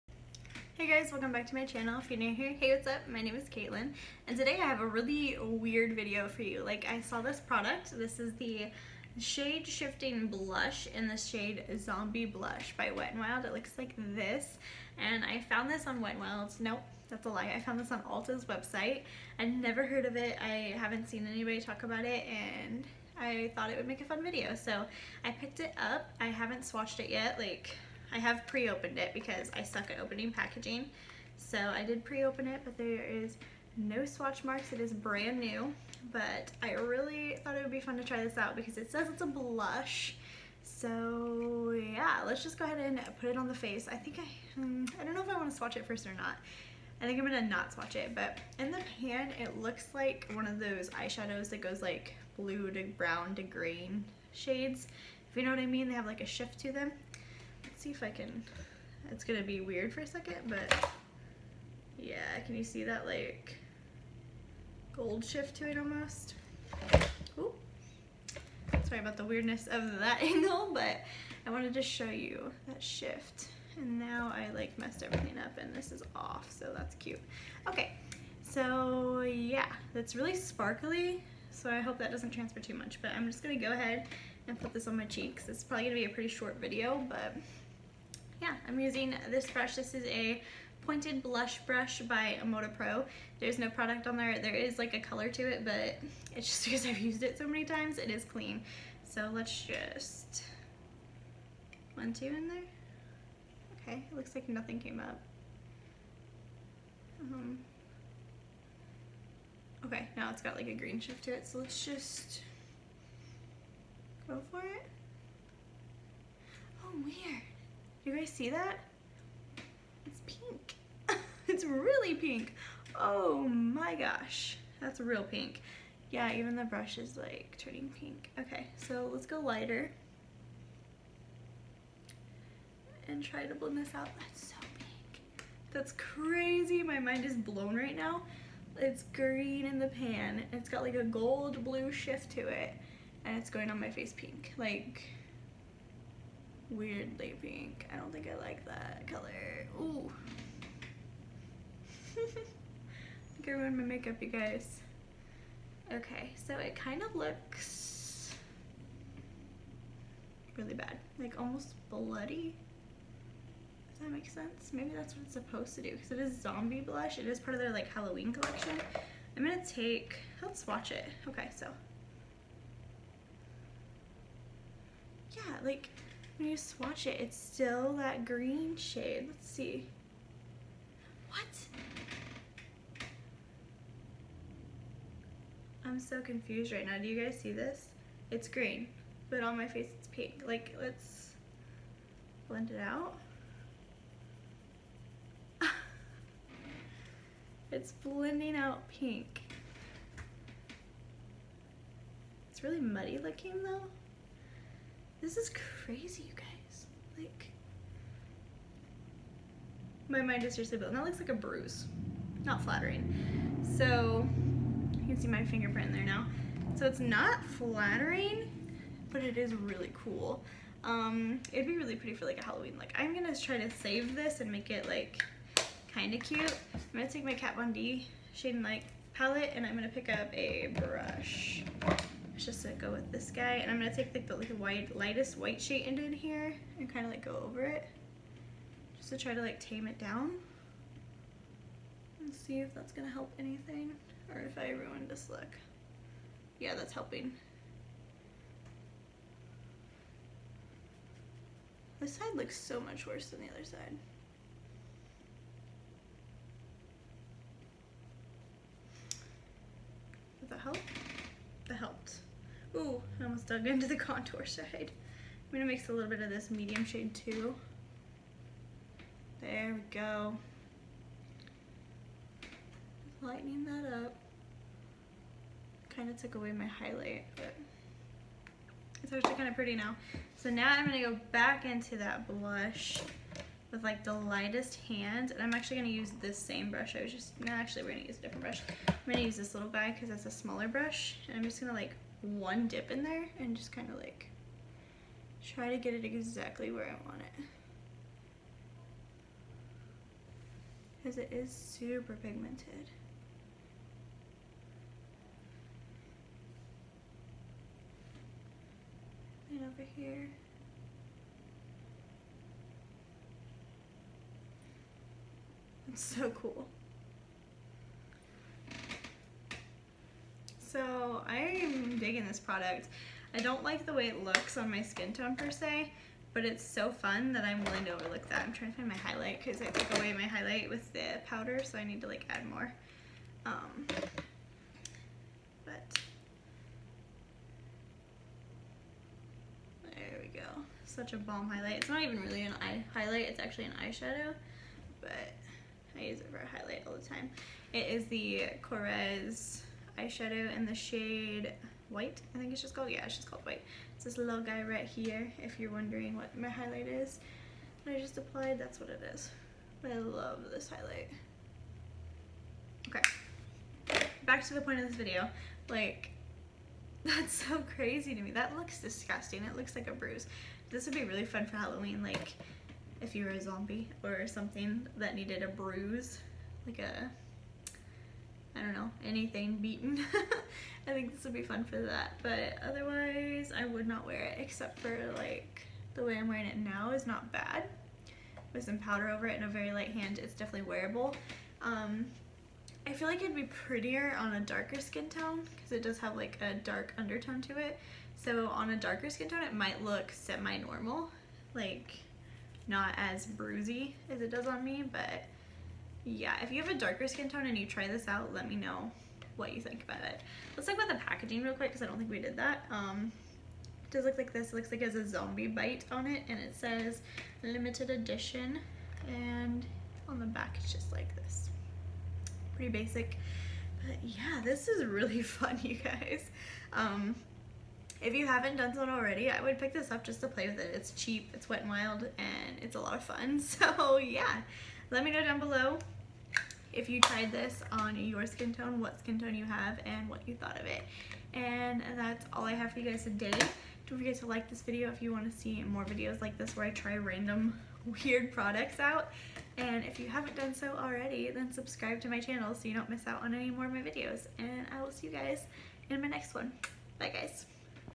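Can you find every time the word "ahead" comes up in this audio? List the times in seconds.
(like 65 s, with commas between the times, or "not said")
42 s, 83 s.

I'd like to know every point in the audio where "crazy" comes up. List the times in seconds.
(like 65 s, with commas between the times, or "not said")
135 s, 205 s, 367 s.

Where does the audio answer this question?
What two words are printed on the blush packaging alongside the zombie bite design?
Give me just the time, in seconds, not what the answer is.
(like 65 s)
417 s.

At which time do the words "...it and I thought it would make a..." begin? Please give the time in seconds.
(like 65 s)
22 s.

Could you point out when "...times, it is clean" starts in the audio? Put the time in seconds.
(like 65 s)
97 s.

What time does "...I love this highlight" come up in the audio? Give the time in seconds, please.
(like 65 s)
359 s.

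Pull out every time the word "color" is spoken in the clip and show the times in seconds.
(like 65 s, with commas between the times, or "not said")
94 s, 149 s.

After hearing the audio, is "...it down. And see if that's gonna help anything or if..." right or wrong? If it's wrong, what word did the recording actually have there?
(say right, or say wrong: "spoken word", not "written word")
right.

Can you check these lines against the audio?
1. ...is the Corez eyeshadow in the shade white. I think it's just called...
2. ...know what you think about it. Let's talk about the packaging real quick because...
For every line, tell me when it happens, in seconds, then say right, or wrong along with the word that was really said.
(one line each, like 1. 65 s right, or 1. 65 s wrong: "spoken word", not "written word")
1. 347 s right
2. 408 s right.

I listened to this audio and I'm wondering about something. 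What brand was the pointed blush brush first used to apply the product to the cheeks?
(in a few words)
Emota Pro.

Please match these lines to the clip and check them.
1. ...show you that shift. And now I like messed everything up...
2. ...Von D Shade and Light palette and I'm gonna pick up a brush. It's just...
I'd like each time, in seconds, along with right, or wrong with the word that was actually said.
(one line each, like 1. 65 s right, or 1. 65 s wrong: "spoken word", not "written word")
1. 71 s right
2. 227 s right.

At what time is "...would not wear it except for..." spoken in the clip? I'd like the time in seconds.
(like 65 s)
383 s.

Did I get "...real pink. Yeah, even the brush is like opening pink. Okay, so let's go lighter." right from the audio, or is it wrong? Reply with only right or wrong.
wrong.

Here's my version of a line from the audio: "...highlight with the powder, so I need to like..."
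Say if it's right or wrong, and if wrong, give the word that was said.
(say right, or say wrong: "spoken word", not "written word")
right.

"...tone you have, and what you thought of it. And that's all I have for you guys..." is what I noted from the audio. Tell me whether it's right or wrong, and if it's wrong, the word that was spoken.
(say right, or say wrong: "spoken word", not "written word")
right.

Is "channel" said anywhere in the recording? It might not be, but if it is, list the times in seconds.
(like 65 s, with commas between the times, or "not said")
1 s, 452 s.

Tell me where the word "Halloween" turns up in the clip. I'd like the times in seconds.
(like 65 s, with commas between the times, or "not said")
167 s, 222 s, 371 s.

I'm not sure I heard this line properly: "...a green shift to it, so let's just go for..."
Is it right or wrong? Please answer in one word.
right.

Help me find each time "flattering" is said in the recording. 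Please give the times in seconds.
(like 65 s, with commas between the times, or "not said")
212 s, 217 s.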